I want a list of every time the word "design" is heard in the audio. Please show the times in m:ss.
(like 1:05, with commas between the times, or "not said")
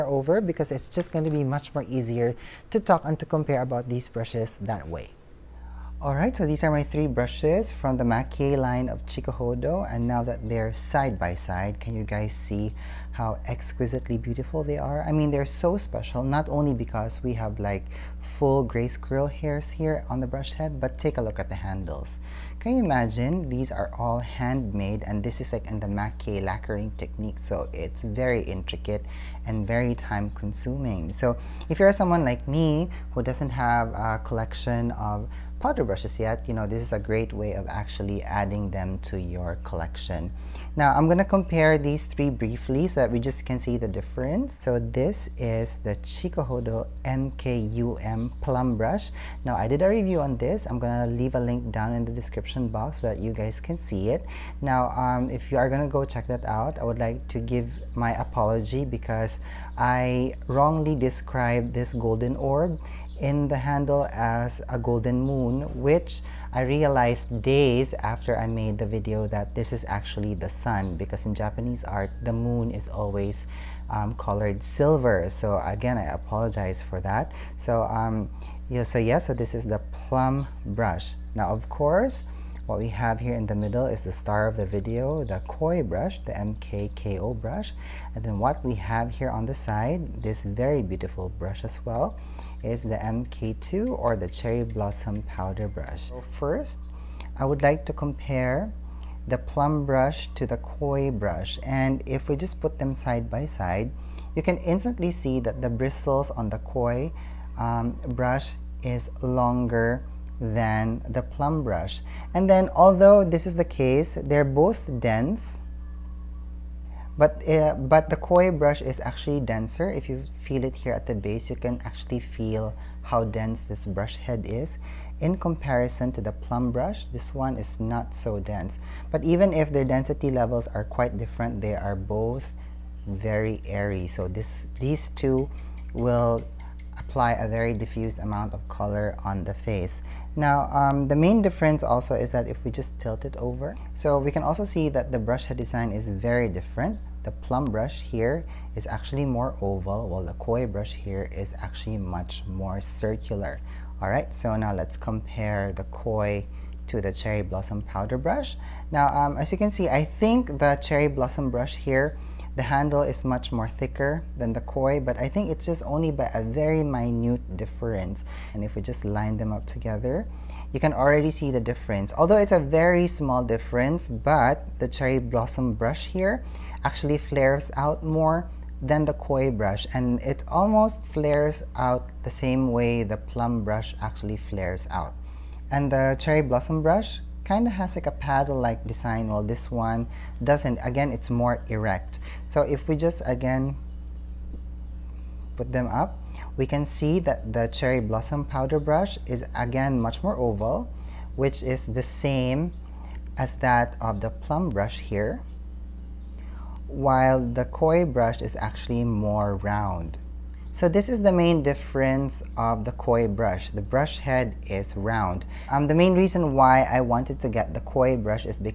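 2:25, 3:08.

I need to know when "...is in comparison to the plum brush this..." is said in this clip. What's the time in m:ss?
2:04.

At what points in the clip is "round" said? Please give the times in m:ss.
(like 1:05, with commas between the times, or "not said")
3:29, 3:34.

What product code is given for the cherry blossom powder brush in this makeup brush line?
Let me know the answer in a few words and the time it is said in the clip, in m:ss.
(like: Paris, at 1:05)
MK2, at 1:32.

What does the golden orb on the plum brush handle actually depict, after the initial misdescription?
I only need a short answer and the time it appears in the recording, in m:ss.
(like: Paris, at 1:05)
the sun, at 1:10.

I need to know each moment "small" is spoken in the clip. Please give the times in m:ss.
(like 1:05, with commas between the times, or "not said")
2:53.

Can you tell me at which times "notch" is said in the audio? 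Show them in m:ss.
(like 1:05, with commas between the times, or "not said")
not said.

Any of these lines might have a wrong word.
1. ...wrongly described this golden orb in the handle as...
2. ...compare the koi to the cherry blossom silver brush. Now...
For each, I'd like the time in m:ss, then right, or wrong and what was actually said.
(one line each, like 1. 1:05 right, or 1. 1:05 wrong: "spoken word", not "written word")
1. 1:00 right
2. 2:34 wrong: "powder", not "silver".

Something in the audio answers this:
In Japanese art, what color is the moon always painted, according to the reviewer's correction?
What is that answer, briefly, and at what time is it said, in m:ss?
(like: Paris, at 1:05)
silver, at 1:14.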